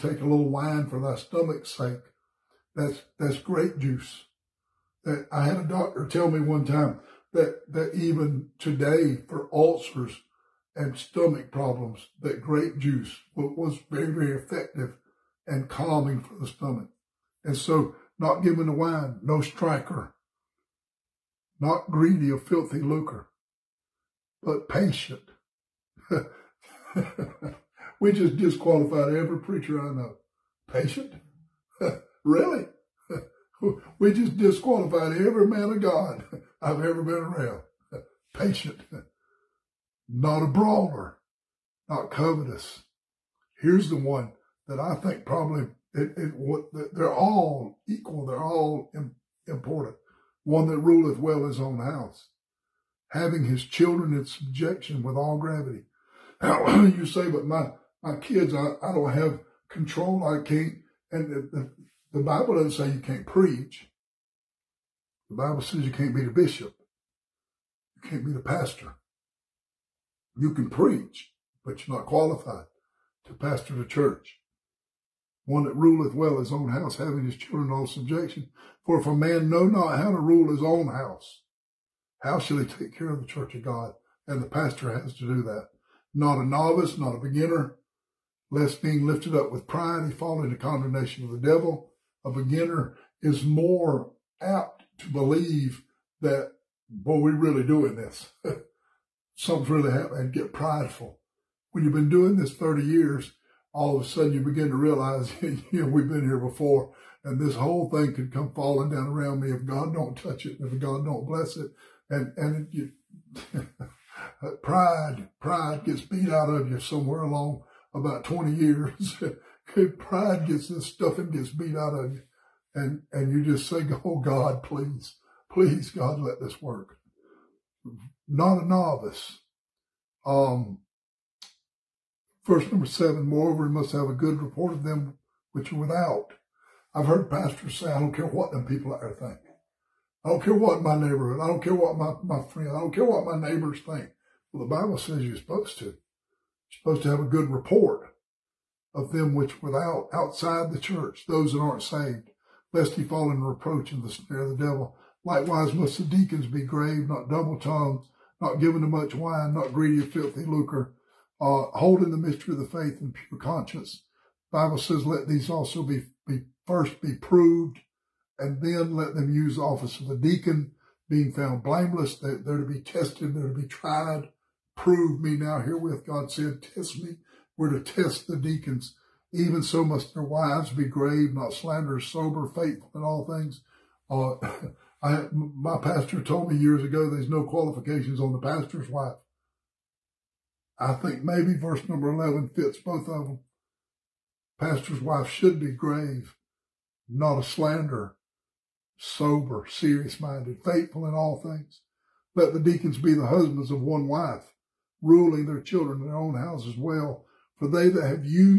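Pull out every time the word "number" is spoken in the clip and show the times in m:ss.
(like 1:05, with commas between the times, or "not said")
2:12, 3:11.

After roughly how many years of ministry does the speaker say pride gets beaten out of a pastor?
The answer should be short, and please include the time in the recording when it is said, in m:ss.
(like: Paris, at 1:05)
20 years, at 1:58.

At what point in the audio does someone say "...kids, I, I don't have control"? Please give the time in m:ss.
0:58.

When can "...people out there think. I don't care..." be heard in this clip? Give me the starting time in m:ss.
2:18.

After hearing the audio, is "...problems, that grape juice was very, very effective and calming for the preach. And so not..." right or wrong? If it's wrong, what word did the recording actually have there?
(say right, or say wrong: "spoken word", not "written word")
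wrong: "stomach", not "preach".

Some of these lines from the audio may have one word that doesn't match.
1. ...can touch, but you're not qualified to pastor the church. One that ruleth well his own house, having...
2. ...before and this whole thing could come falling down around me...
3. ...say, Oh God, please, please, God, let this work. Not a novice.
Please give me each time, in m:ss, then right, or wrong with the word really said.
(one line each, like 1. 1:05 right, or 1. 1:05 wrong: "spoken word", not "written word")
1. 1:10 wrong: "preach", not "touch"
2. 1:46 right
3. 2:03 right.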